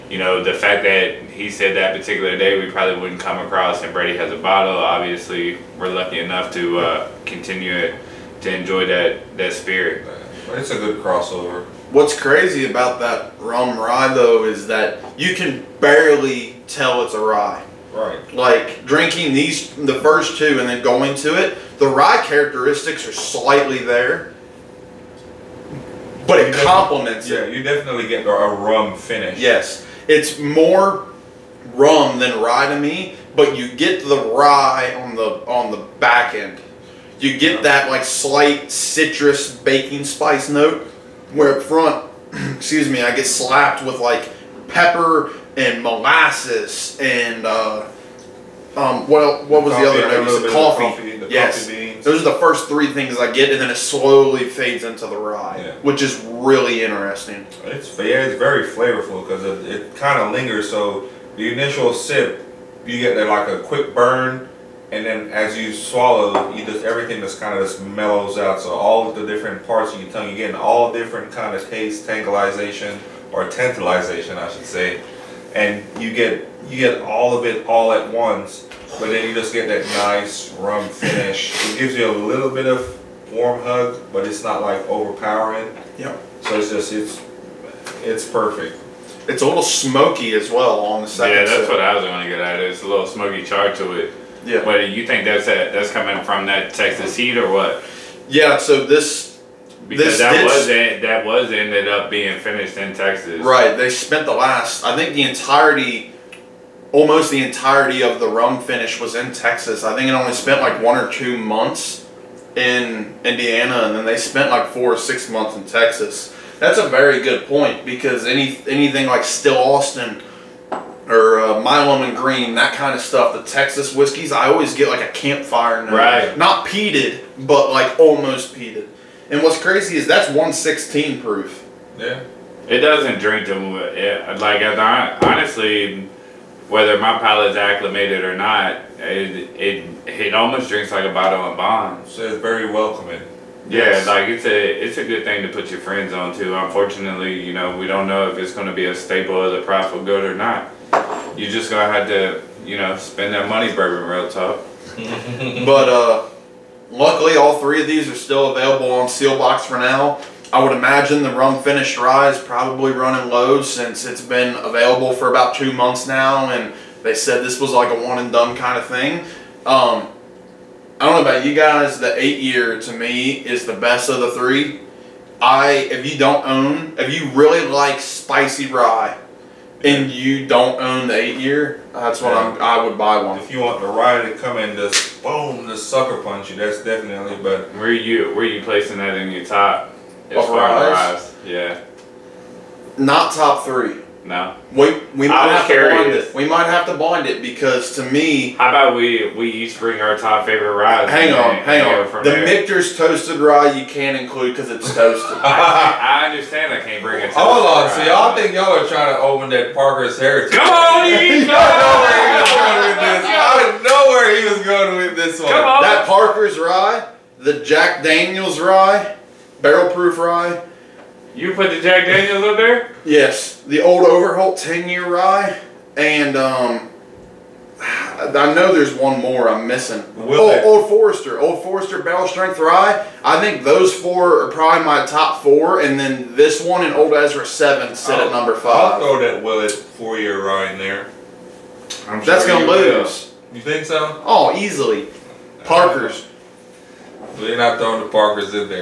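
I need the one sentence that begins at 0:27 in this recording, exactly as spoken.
you definitely get a rum finish.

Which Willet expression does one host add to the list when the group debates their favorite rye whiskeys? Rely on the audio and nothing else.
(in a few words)
Willet four year rye.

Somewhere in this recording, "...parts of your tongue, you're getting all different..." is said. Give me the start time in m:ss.
1:09.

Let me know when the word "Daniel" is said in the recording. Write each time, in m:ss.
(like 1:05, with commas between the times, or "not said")
3:38, 3:42.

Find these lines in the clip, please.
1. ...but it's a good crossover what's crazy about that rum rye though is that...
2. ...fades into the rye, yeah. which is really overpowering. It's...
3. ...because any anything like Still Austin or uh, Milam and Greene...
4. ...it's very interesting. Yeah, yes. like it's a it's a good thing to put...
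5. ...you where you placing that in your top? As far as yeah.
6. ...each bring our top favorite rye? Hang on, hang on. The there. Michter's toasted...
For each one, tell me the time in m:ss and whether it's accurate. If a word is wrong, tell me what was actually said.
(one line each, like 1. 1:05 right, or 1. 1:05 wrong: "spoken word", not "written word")
1. 0:10 right
2. 0:54 wrong: "interesting", not "overpowering"
3. 1:57 right
4. 2:22 wrong: "welcoming", not "interesting"
5. 3:07 right
6. 3:19 right.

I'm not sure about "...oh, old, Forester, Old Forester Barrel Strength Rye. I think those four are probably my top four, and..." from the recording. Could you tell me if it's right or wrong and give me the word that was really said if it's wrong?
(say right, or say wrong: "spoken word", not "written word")
right.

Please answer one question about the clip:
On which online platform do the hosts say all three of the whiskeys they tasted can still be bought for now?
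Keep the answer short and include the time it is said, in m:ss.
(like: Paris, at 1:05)
Sealbox, at 2:39.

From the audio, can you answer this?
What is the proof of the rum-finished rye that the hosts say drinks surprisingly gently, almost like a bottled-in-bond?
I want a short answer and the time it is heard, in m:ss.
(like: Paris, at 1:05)
116, at 2:10.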